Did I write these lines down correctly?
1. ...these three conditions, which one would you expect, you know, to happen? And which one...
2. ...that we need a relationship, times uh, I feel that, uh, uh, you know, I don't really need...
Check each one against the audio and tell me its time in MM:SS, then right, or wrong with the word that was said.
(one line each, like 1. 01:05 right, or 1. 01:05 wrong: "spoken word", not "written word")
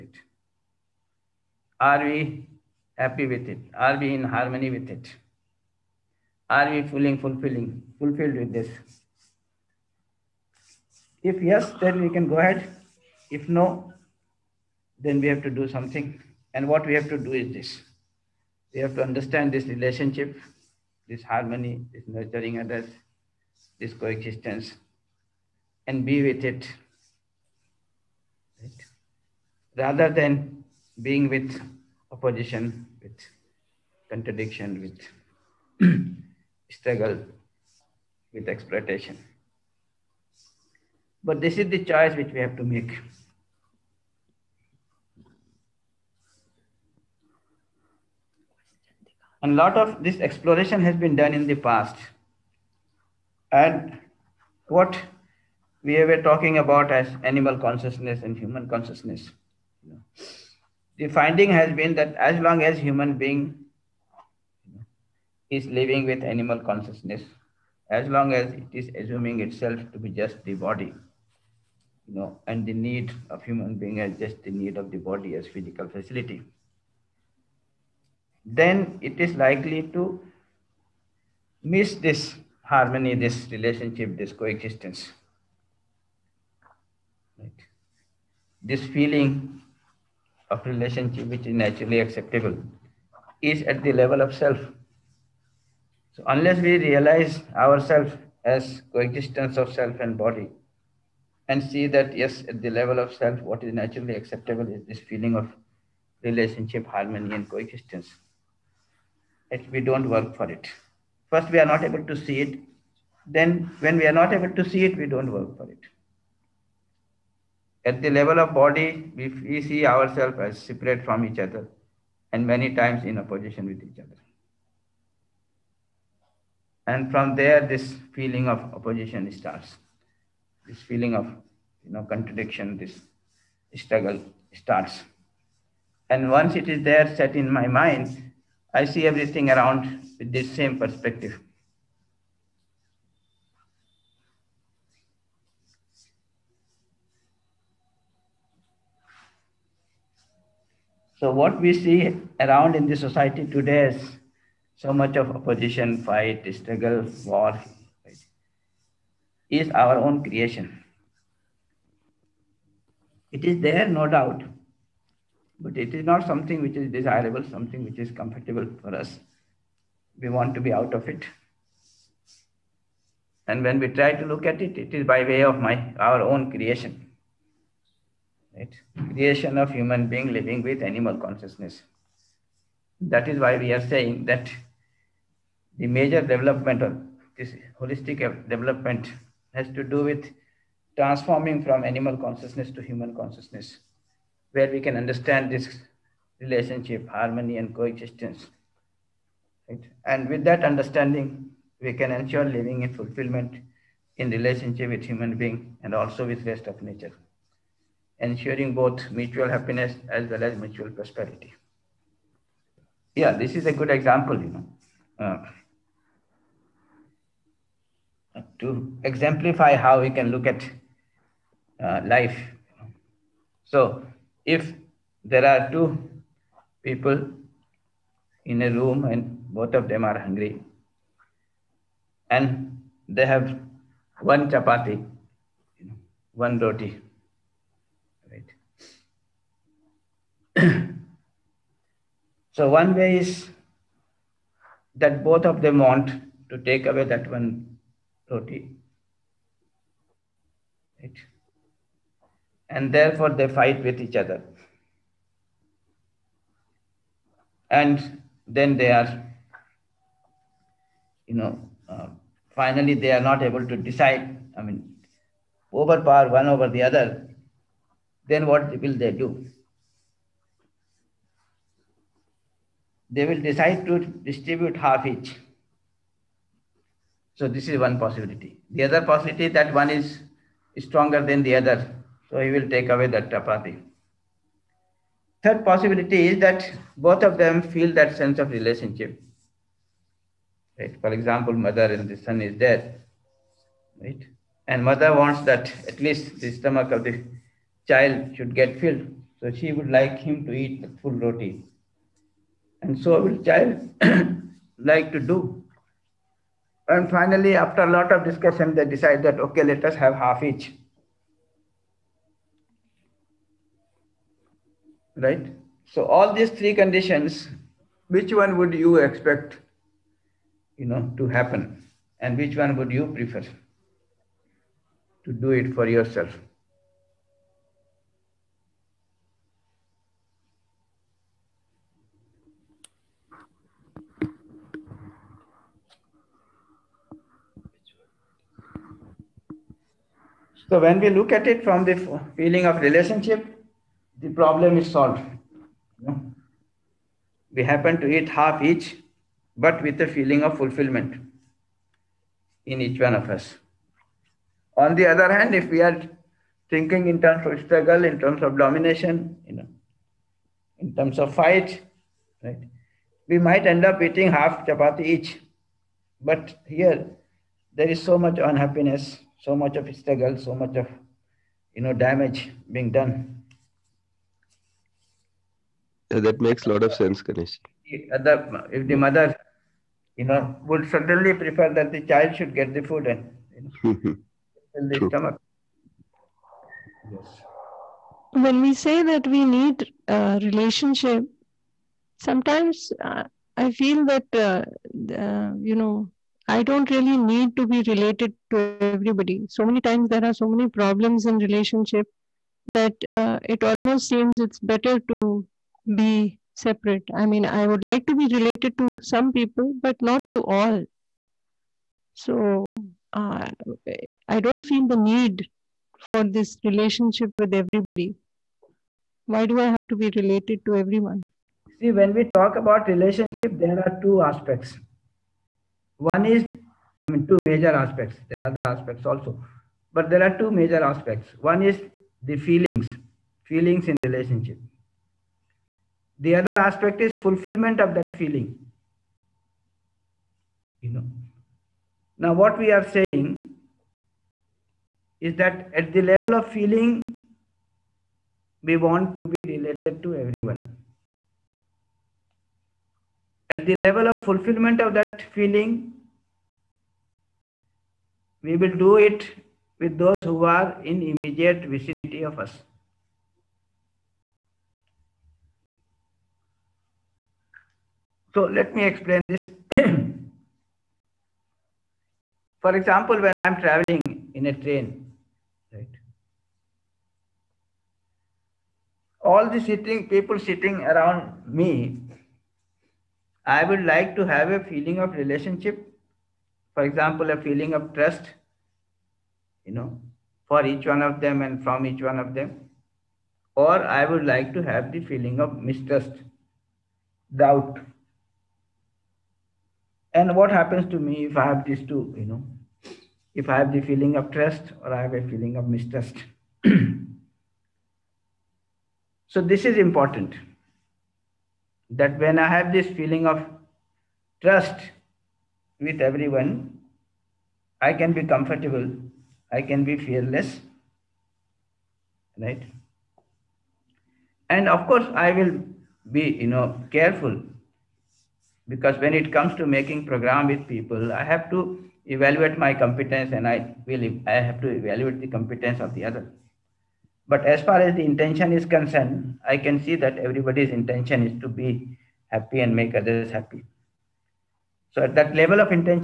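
1. 05:16 right
2. 06:29 wrong: "sometimes", not "times".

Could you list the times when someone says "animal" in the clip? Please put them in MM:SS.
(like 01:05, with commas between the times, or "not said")
00:57, 01:06, 03:00, 03:11.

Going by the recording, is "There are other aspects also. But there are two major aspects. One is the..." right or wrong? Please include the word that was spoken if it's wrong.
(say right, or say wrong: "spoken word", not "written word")
right.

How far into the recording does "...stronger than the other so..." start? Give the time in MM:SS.
04:40.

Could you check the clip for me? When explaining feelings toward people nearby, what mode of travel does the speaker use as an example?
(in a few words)
Train.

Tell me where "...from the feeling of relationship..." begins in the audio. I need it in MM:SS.
05:41.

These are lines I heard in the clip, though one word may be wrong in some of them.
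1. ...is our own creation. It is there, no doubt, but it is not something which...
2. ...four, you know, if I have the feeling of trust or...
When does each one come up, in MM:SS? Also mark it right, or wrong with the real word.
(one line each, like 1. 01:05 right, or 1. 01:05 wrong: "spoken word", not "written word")
1. 02:39 right
2. 08:21 wrong: "two", not "four".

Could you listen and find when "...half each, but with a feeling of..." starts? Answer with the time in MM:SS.
05:48.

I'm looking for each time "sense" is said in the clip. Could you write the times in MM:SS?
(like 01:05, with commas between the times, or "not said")
04:48, 06:16.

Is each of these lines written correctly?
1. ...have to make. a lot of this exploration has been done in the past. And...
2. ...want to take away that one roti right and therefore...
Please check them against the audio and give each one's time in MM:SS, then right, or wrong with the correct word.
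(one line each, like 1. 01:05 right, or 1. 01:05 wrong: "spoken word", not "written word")
1. 00:42 right
2. 04:05 right.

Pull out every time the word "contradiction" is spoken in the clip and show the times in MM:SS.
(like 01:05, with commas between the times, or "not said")
00:34, 02:12.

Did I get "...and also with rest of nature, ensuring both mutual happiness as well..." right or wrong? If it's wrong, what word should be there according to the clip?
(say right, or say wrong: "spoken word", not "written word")
right.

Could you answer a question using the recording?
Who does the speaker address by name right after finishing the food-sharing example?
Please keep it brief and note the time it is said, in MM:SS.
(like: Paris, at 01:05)
Ganesh, at 06:17.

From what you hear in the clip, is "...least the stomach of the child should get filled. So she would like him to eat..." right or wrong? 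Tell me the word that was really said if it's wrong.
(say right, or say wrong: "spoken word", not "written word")
right.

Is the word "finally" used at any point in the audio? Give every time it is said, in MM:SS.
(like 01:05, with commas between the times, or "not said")
04:22, 05:07.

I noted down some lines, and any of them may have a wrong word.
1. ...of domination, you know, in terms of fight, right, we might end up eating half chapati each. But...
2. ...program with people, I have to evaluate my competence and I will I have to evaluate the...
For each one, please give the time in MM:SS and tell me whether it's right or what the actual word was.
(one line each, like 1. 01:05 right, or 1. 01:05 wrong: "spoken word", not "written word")
1. 05:58 right
2. 08:50 right.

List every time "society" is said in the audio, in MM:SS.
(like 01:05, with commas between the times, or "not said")
02:32.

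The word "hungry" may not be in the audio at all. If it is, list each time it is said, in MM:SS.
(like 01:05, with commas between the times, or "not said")
03:50.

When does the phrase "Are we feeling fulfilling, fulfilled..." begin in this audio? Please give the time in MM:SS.
00:06.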